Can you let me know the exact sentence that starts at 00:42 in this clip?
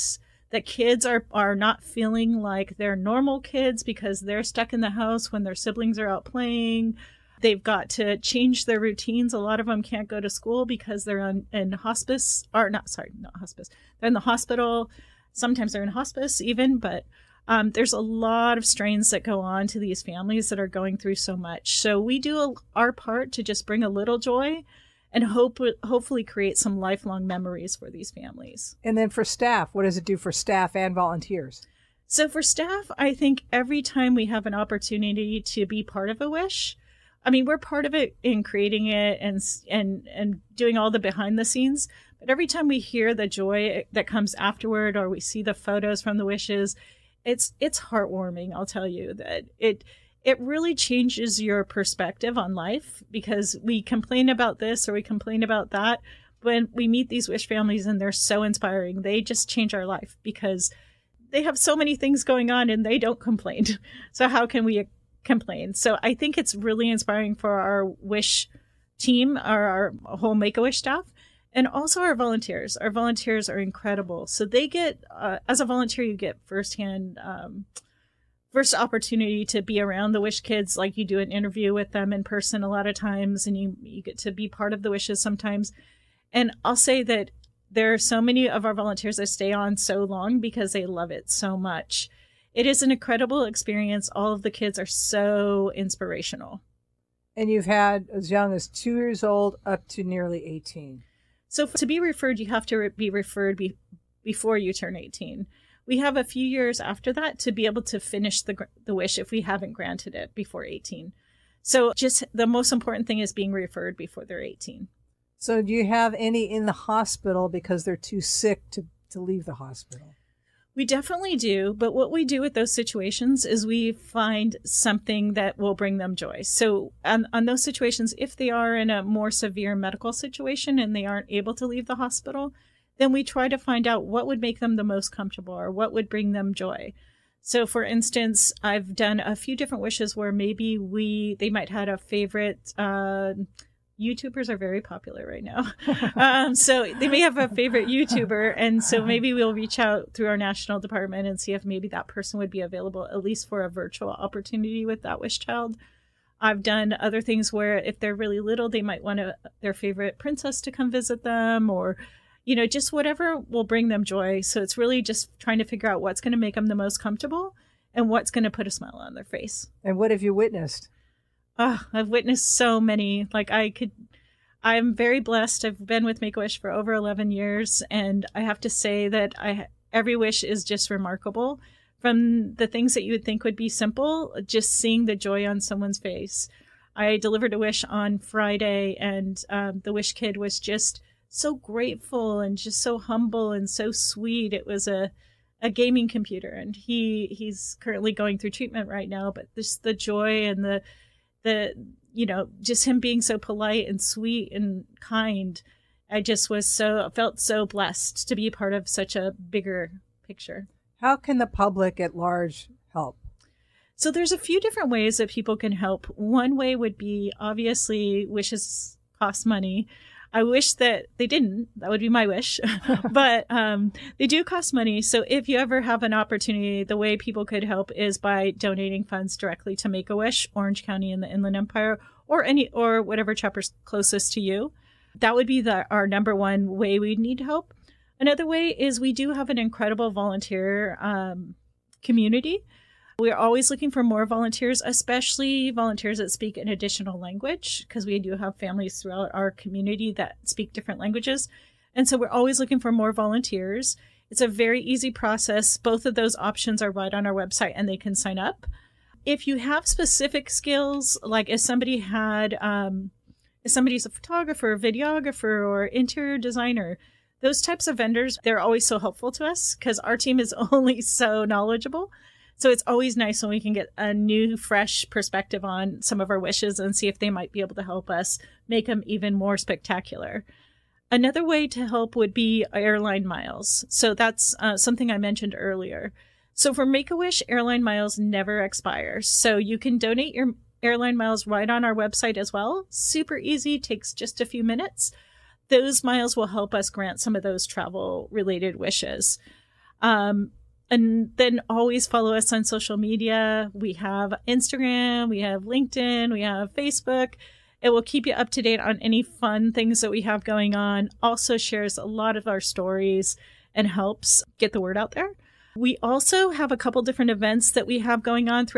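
But every time we hear the joy that comes afterward, or we see the photos from the wishes, it's it's heartwarming.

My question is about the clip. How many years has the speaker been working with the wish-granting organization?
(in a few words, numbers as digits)
over 11 years.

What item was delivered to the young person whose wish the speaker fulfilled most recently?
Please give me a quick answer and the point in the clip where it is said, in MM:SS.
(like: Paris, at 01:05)
gaming computer, at 03:15.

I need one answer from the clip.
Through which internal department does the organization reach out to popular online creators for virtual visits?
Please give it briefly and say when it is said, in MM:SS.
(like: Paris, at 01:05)
national department, at 02:30.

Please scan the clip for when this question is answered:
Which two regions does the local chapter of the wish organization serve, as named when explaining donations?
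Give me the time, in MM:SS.
03:50.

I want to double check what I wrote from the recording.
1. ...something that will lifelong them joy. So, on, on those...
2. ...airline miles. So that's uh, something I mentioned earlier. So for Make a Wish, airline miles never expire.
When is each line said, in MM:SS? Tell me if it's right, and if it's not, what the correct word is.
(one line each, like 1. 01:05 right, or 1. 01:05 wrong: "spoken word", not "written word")
1. 02:04 wrong: "bring", not "lifelong"
2. 04:42 right.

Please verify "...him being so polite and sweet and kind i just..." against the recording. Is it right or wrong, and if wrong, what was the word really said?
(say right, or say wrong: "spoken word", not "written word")
right.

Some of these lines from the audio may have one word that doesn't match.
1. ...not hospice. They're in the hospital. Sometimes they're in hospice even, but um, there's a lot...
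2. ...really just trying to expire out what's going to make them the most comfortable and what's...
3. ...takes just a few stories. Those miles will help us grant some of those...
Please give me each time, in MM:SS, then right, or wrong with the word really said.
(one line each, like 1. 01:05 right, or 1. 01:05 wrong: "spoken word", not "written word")
1. 00:13 right
2. 02:44 wrong: "figure", not "expire"
3. 04:53 wrong: "minutes", not "stories".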